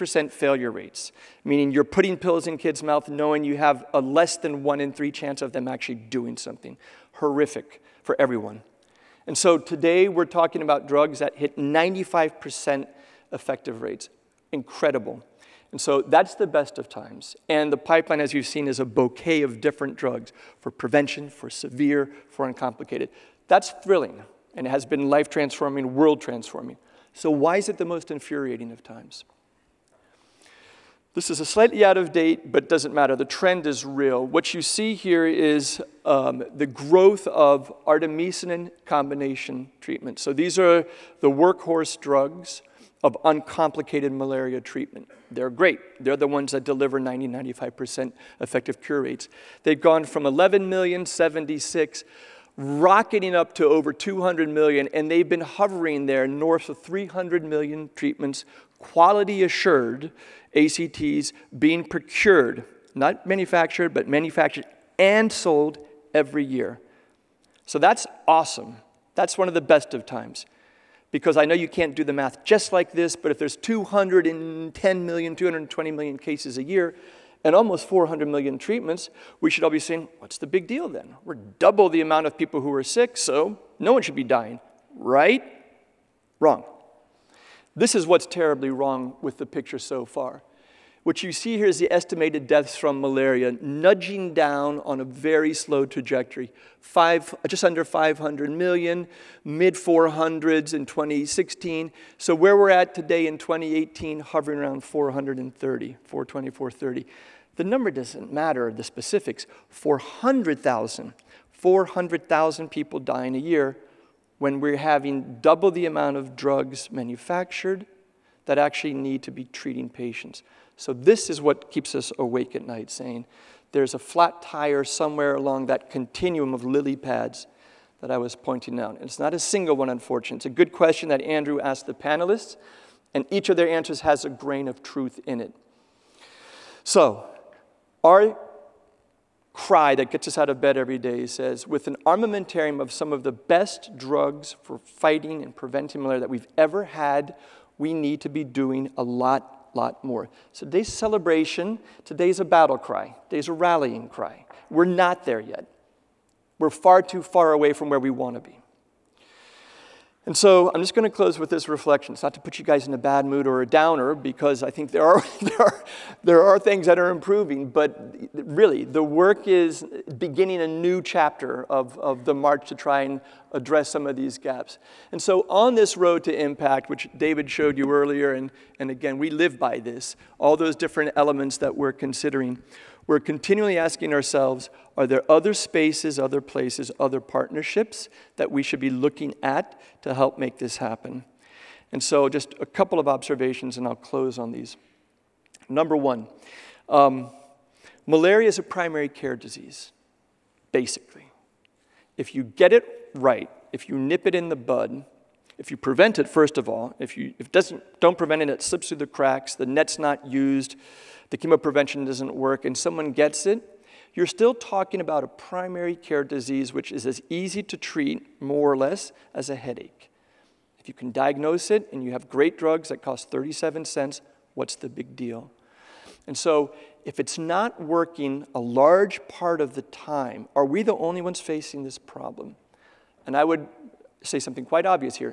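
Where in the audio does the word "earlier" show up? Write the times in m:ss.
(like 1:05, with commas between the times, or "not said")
2:57.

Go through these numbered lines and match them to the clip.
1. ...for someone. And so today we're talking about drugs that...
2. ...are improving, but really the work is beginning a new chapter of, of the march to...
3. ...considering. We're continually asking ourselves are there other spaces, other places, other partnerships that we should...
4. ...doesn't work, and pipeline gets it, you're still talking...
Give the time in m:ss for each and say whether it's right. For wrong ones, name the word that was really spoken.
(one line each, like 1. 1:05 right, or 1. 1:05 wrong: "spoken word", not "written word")
1. 0:08 wrong: "everyone", not "someone"
2. 2:46 right
3. 3:01 right
4. 3:32 wrong: "someone", not "pipeline".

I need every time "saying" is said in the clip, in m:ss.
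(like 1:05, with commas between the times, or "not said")
1:19, 2:02.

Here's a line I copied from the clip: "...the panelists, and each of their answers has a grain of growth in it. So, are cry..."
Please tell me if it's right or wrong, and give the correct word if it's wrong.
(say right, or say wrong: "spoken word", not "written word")
wrong: "truth", not "growth".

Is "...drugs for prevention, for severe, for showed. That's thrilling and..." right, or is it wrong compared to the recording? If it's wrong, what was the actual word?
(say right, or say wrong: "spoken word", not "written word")
wrong: "uncomplicated", not "showed".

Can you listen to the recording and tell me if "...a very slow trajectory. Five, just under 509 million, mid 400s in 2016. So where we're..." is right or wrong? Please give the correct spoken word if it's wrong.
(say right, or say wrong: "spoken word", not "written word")
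wrong: "500", not "509".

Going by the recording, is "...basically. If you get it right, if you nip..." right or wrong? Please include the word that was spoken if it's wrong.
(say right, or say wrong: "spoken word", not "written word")
right.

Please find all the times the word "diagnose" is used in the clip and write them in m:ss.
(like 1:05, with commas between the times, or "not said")
3:41.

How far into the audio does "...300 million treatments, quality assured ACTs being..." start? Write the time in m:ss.
0:56.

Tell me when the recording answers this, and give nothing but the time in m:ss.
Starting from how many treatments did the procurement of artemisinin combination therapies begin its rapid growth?
0:50.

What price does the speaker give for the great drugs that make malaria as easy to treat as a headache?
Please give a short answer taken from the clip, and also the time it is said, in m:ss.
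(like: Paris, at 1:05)
37 cents, at 3:43.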